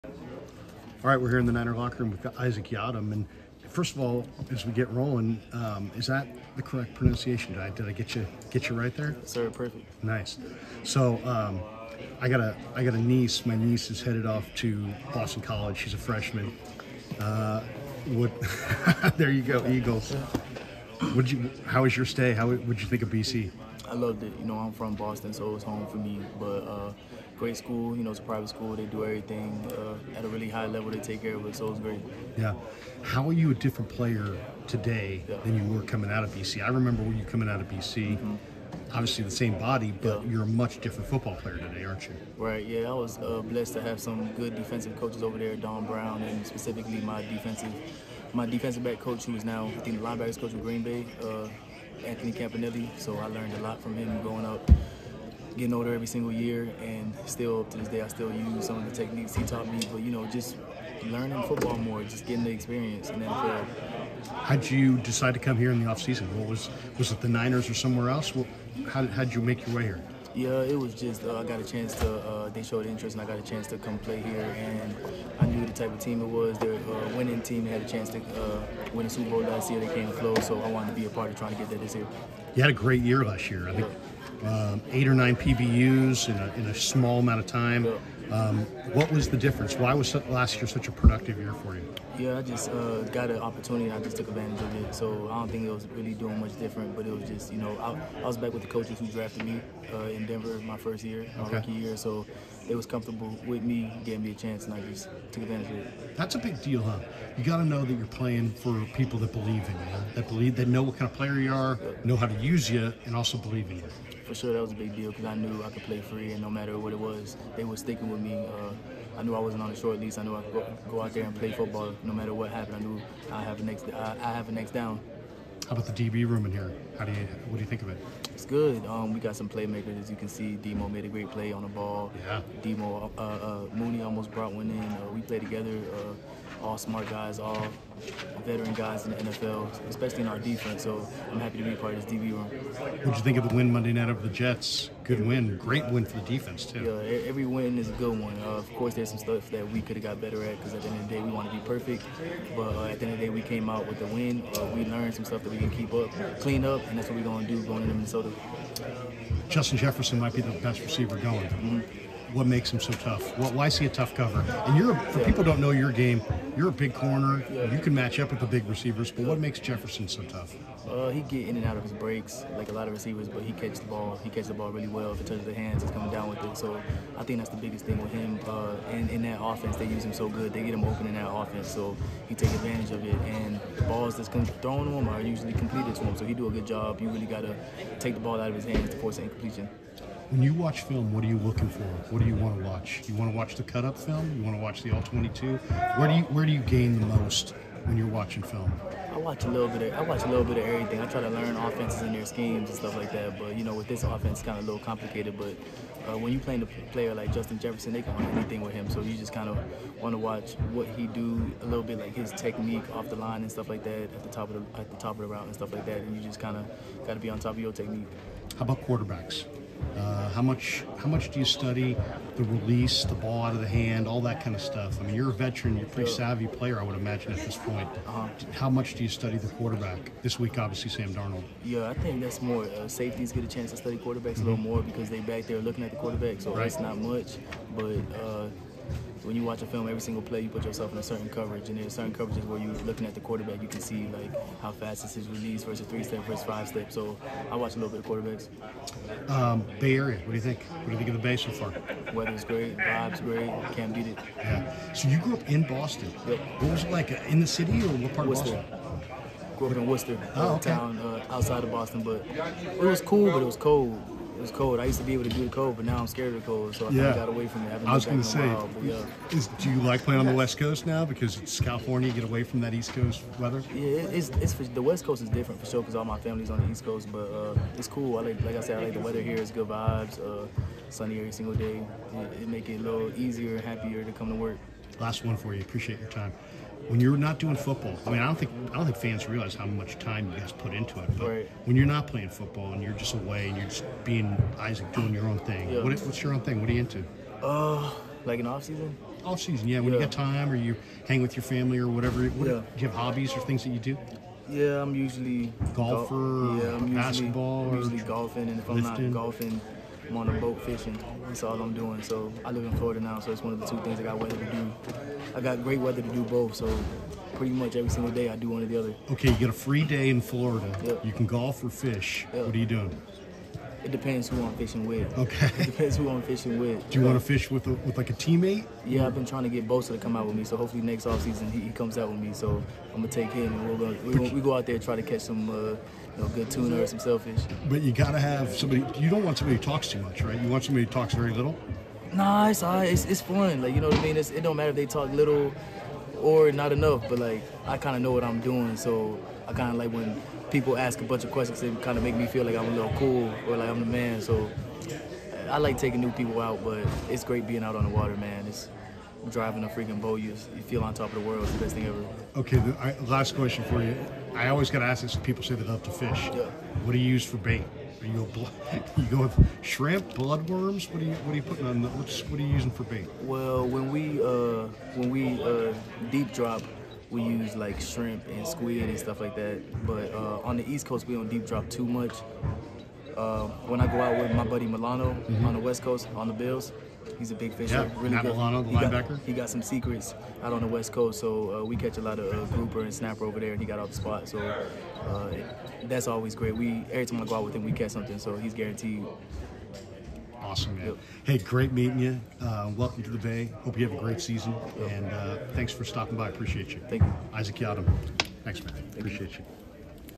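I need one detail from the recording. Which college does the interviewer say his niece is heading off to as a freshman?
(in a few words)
Boston College.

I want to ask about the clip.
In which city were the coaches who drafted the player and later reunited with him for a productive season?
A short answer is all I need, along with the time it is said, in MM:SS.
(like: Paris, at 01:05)
Denver, at 01:40.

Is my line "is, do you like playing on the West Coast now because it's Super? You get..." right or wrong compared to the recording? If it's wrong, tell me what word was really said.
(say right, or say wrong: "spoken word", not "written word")
wrong: "California", not "Super".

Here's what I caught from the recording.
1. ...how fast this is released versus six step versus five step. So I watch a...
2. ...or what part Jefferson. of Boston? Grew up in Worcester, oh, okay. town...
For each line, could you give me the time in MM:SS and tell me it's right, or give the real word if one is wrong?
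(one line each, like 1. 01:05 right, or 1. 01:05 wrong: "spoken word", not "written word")
1. 04:04 wrong: "three", not "six"
2. 04:17 wrong: "Worcester", not "Jefferson".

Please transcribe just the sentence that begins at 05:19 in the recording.
Okay, you get a free day in Florida.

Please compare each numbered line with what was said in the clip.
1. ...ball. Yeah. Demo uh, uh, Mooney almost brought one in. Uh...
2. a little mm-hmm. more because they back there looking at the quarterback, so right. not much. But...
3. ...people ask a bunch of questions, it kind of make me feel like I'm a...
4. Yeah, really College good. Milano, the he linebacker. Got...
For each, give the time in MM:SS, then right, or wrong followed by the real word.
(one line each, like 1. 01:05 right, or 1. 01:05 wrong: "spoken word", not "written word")
1. 02:11 right
2. 03:54 right
3. 05:50 right
4. 06:27 wrong: "Matt", not "College".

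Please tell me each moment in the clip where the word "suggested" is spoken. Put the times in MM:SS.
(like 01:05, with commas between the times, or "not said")
not said.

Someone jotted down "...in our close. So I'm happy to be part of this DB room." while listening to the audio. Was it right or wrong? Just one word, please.
wrong.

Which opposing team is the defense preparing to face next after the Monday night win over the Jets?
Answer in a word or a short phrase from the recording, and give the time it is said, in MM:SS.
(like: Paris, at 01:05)
Minnesota, at 02:37.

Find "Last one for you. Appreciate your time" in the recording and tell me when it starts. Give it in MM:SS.
04:45.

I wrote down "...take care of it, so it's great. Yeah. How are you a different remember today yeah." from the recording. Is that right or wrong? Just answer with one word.
wrong.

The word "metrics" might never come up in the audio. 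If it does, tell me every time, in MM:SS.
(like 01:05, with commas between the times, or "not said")
not said.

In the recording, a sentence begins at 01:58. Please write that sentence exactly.
Uh, I knew I wasn't on a short lease.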